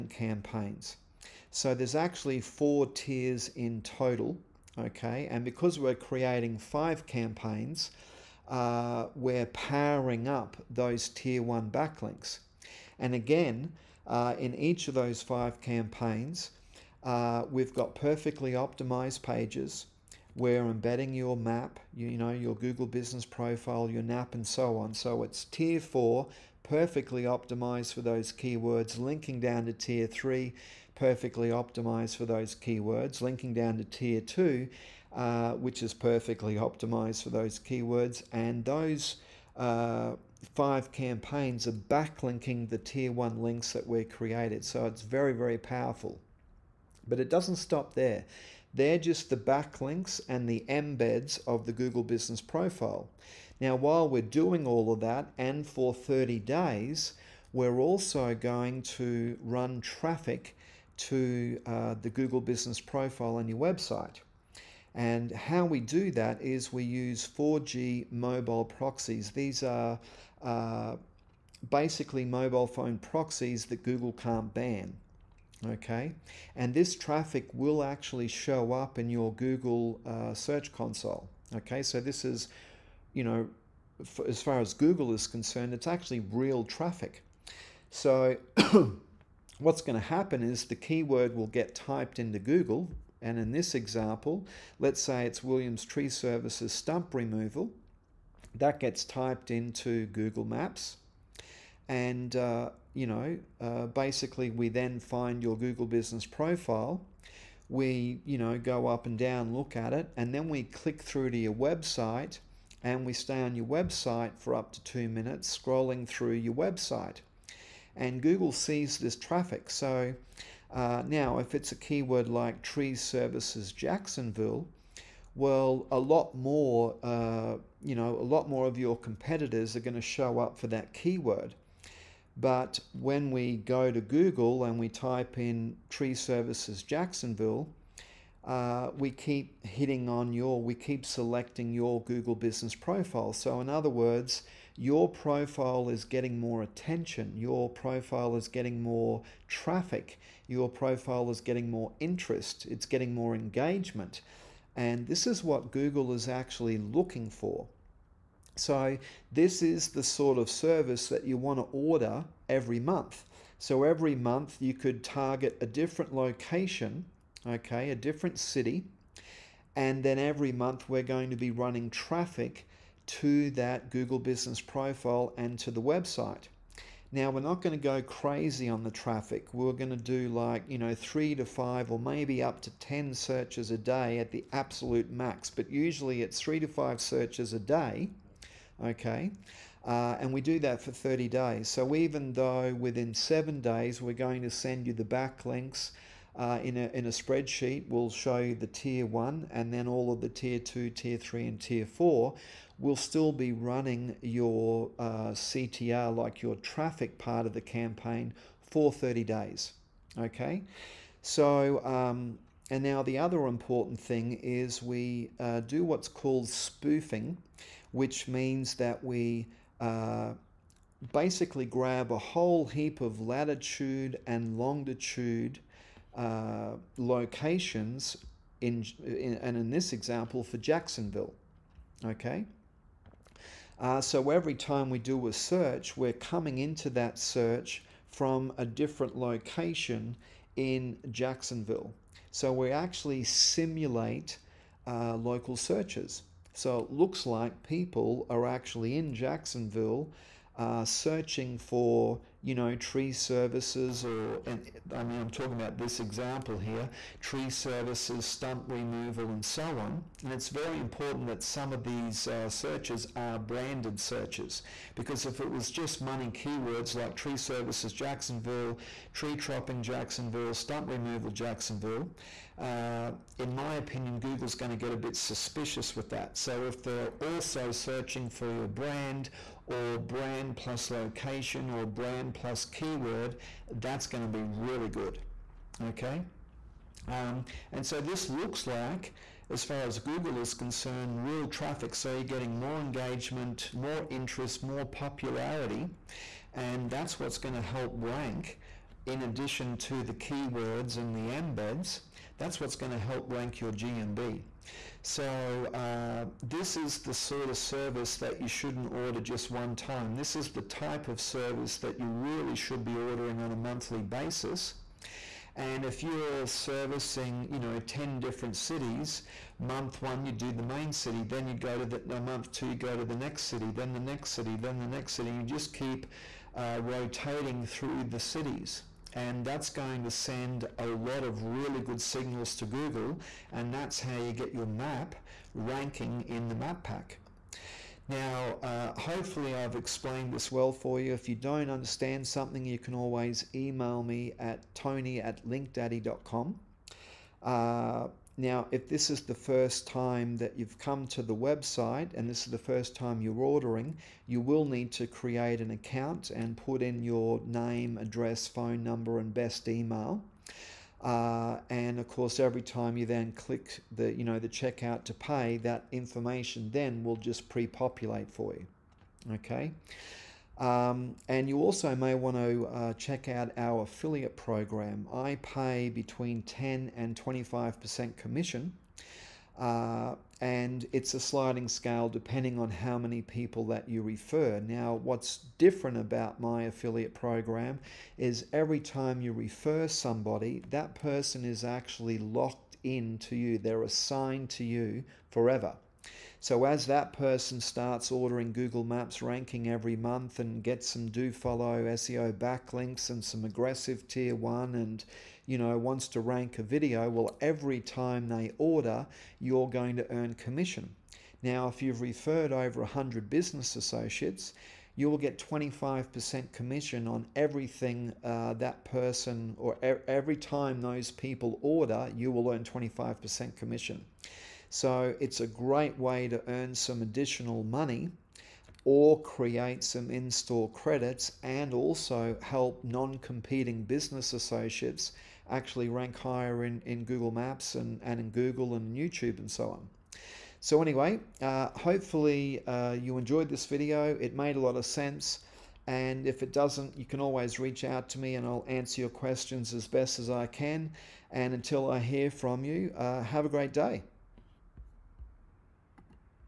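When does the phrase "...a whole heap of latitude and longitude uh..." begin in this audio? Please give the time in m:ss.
3:42.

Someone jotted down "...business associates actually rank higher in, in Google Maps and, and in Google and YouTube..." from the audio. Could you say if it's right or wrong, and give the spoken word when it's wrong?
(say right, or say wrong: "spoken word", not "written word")
right.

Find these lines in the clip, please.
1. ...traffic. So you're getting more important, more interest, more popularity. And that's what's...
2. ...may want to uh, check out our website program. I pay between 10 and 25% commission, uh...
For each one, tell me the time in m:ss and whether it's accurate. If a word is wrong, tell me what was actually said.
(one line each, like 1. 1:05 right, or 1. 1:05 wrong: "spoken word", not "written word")
1. 4:51 wrong: "engagement", not "important"
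2. 6:11 wrong: "affiliate", not "website".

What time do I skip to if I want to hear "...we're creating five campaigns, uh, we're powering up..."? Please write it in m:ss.
0:05.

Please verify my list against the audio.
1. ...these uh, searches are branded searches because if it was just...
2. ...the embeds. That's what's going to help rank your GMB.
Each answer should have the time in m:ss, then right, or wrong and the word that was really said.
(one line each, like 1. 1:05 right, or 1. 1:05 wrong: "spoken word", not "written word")
1. 4:21 right
2. 5:01 right.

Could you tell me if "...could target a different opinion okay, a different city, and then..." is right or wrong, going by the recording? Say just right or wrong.
wrong.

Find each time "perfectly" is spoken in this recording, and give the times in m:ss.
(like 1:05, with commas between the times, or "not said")
0:17, 0:26, 0:30, 0:35.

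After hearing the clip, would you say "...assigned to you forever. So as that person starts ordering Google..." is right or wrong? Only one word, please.
right.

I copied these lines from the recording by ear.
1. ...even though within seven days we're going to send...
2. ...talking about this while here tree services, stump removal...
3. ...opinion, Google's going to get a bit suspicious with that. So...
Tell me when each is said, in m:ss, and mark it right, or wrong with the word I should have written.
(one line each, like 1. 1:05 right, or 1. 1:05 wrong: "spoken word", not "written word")
1. 3:11 right
2. 4:15 wrong: "example", not "while"
3. 4:33 right.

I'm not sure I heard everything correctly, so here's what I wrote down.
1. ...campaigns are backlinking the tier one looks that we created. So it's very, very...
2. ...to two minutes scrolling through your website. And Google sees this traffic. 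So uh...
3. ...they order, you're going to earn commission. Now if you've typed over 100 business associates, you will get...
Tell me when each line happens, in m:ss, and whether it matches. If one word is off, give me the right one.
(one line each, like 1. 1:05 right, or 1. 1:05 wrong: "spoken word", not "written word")
1. 0:40 wrong: "links", not "looks"
2. 1:54 right
3. 6:48 wrong: "referred", not "typed".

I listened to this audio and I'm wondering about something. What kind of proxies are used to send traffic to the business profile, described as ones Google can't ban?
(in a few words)
4G mobile proxies.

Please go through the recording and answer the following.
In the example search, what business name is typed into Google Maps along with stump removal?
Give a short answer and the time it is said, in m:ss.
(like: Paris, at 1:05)
Williams Tree Services, at 1:35.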